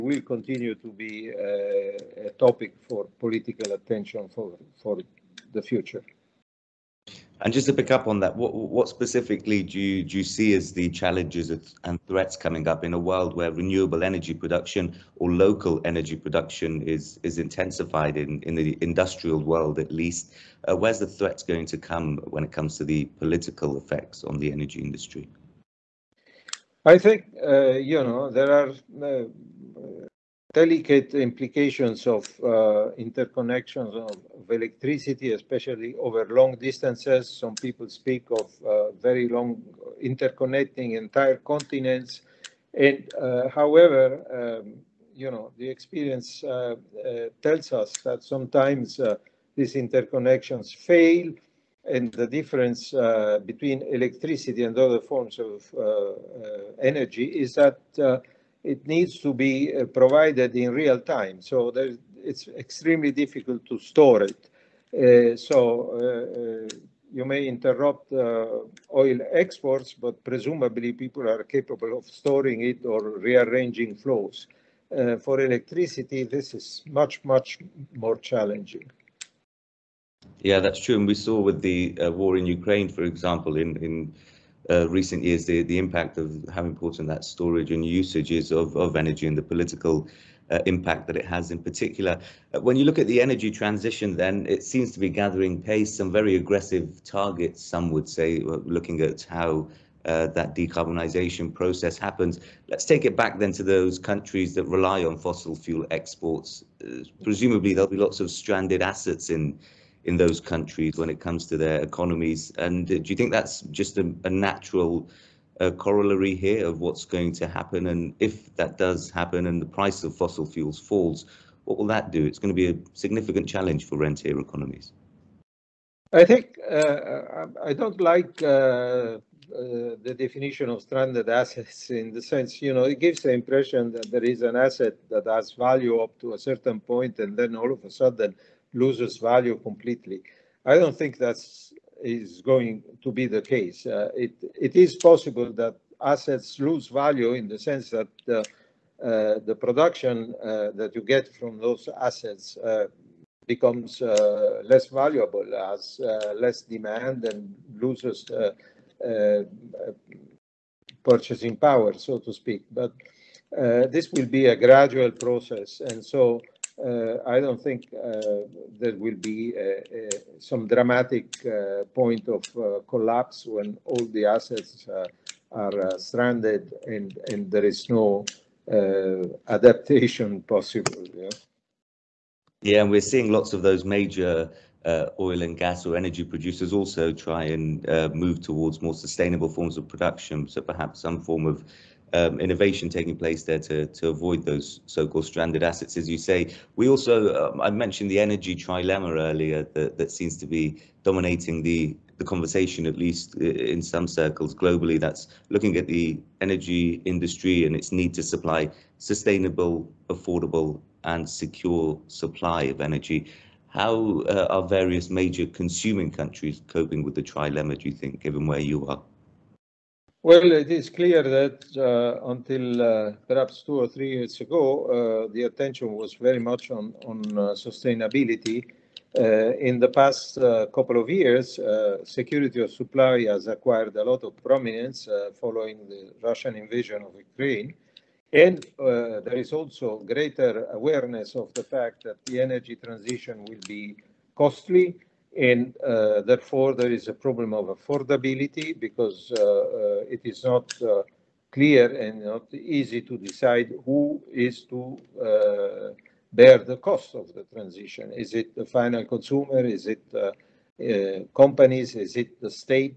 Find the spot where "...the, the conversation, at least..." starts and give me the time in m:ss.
3:21.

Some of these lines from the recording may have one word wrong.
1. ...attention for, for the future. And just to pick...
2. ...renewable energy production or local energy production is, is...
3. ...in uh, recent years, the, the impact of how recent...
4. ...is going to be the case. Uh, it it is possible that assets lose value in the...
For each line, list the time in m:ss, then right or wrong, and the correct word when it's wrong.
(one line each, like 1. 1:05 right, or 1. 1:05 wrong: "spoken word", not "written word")
1. 0:03 right
2. 0:13 right
3. 1:23 wrong: "important", not "recent"
4. 2:22 right.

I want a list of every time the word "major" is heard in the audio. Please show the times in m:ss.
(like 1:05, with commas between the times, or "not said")
3:03, 3:35.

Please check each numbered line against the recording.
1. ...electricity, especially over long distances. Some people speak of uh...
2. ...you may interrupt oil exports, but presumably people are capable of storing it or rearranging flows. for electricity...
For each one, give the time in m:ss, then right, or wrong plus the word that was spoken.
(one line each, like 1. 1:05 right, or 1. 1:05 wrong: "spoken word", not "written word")
1. 0:34 right
2. 1:07 right.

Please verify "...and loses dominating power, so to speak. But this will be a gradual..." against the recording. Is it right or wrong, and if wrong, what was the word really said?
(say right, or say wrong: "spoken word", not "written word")
wrong: "purchasing", not "dominating".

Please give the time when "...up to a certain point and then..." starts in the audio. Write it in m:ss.
2:15.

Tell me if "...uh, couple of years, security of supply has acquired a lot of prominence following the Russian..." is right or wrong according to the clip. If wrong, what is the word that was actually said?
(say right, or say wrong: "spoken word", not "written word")
right.